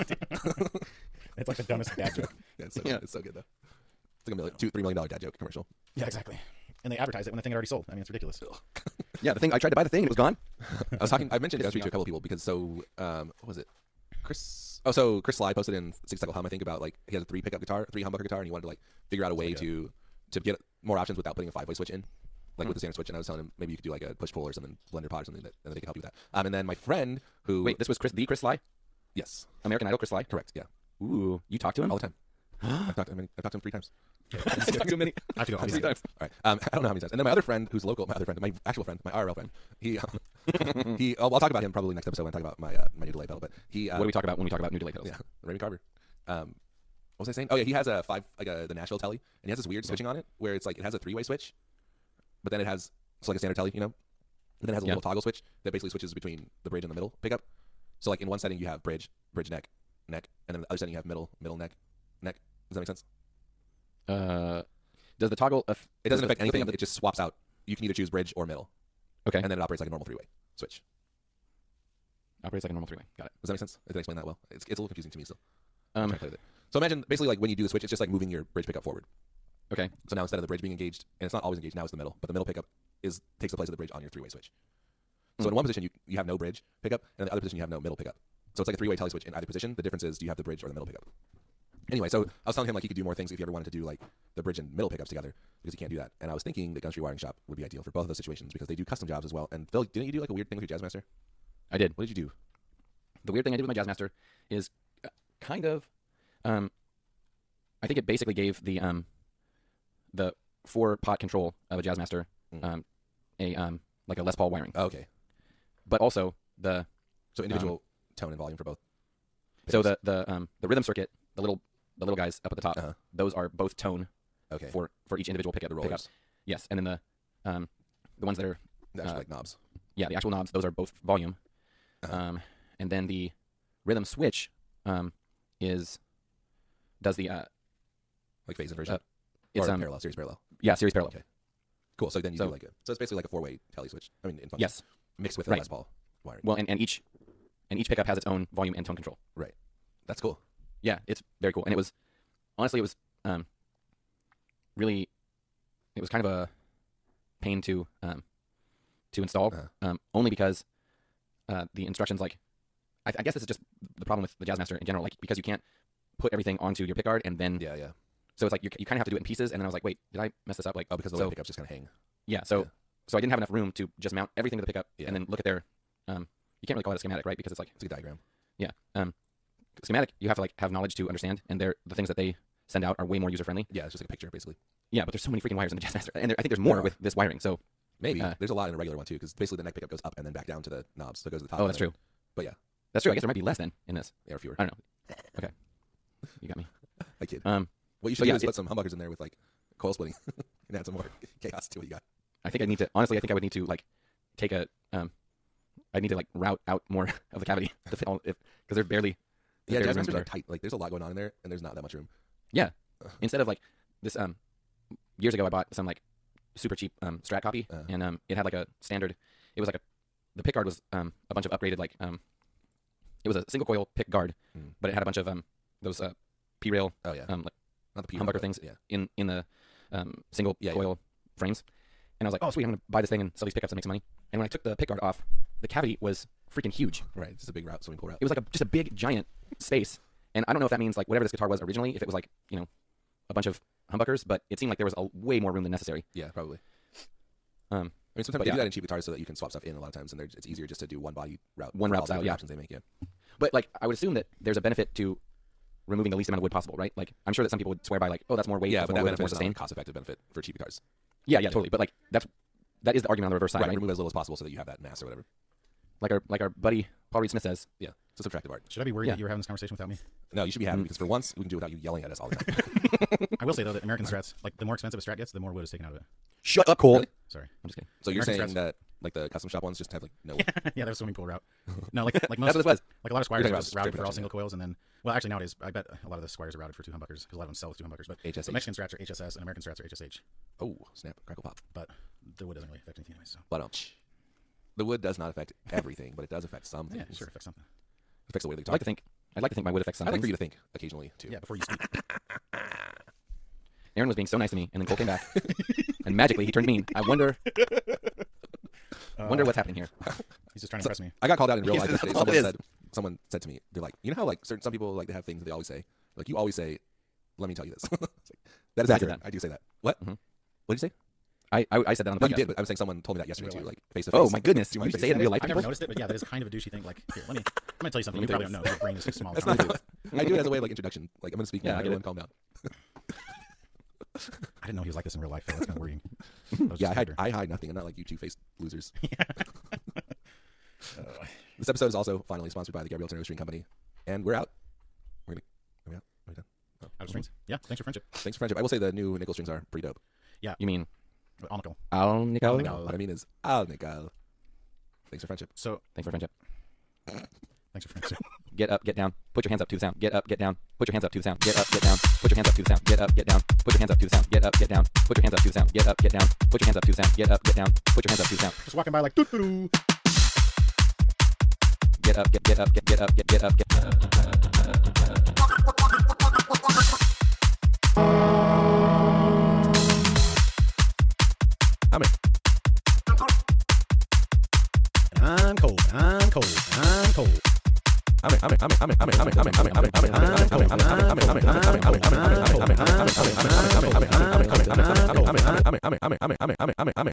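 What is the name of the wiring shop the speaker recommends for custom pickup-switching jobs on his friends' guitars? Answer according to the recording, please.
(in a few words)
Gunstreet Wiring Shop.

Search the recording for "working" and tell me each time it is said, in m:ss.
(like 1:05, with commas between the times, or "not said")
not said.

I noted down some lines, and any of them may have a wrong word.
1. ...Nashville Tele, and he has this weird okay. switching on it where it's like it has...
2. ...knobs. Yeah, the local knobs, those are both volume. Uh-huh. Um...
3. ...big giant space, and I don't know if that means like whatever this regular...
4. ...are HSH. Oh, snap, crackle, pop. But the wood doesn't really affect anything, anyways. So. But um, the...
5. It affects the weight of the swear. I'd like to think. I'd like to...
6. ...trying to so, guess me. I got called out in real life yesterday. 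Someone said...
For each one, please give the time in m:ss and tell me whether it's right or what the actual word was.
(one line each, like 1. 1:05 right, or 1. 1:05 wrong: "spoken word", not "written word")
1. 0:48 right
2. 2:09 wrong: "actual", not "local"
3. 3:58 wrong: "guitar", not "regular"
4. 4:49 right
5. 4:58 wrong: "guitar", not "swear"
6. 5:10 wrong: "impress", not "guess".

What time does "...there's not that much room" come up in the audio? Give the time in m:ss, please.
3:31.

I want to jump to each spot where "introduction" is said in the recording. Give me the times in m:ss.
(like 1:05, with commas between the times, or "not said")
5:30.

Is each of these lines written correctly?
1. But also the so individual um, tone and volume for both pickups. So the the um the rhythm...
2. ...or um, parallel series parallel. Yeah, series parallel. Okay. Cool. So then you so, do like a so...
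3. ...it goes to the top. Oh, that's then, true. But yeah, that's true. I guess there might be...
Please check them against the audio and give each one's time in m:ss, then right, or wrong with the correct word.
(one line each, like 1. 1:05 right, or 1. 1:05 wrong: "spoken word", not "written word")
1. 1:55 right
2. 2:19 right
3. 3:11 right.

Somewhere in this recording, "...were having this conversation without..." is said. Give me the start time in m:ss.
4:29.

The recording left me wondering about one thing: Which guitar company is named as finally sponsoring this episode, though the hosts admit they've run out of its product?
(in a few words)
Gabriel Tenorio String Company.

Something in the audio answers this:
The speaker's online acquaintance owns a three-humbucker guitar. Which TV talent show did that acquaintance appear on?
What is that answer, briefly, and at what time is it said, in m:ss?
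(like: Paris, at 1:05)
American Idol, at 0:29.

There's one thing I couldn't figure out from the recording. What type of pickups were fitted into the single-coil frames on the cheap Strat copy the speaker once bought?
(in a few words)
P rail.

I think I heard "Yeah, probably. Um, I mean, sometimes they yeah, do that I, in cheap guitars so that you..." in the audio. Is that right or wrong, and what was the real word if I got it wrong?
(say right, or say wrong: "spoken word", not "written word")
right.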